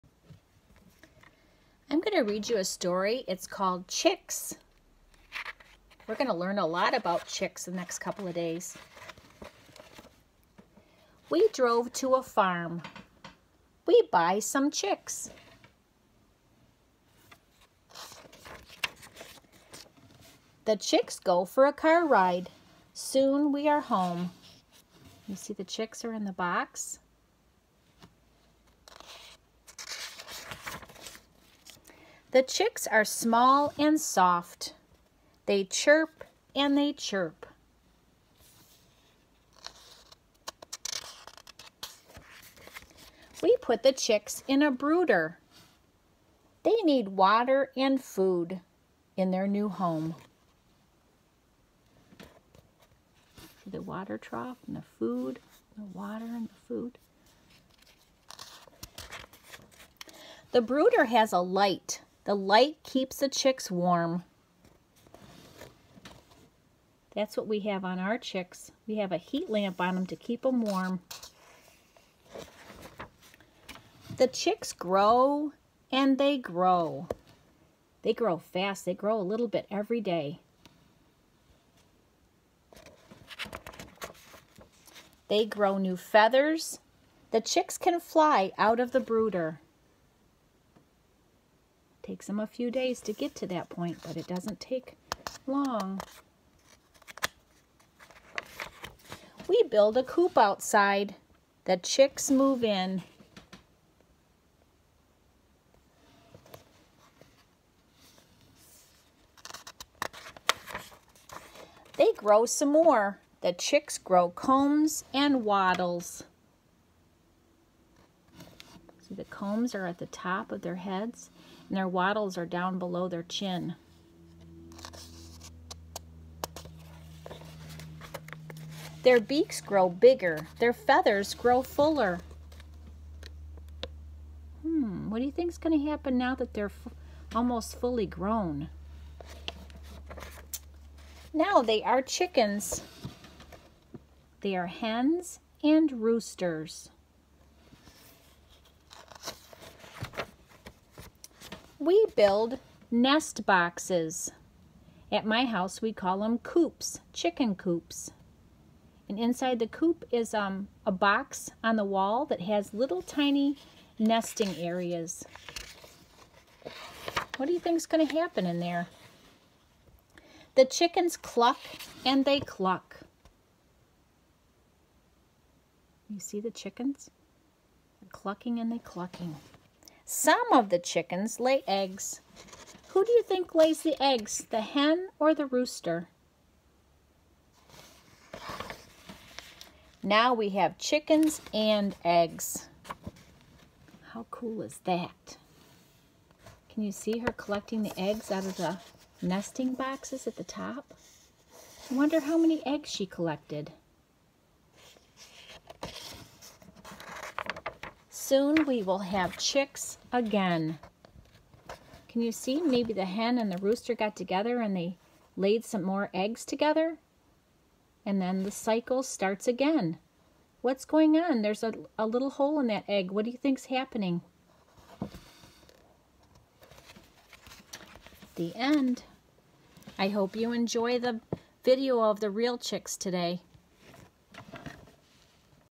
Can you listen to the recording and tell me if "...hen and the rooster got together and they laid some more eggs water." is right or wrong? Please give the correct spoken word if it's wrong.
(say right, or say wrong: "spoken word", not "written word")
wrong: "together", not "water".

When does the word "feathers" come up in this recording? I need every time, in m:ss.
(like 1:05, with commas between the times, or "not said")
1:25, 2:10.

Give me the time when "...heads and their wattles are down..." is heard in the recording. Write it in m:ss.
2:00.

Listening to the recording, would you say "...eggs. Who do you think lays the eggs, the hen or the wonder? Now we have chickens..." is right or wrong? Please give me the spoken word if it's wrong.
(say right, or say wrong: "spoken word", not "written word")
wrong: "rooster", not "wonder".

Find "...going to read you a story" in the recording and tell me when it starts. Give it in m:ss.
0:02.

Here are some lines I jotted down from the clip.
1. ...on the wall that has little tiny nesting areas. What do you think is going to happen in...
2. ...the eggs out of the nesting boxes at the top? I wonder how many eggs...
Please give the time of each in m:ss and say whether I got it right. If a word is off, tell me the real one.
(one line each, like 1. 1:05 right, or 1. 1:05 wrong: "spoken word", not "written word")
1. 2:41 right
2. 3:17 right.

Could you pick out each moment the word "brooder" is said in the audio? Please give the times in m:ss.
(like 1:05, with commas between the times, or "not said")
0:44, 1:00, 1:28.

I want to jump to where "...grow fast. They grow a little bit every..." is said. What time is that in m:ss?
1:18.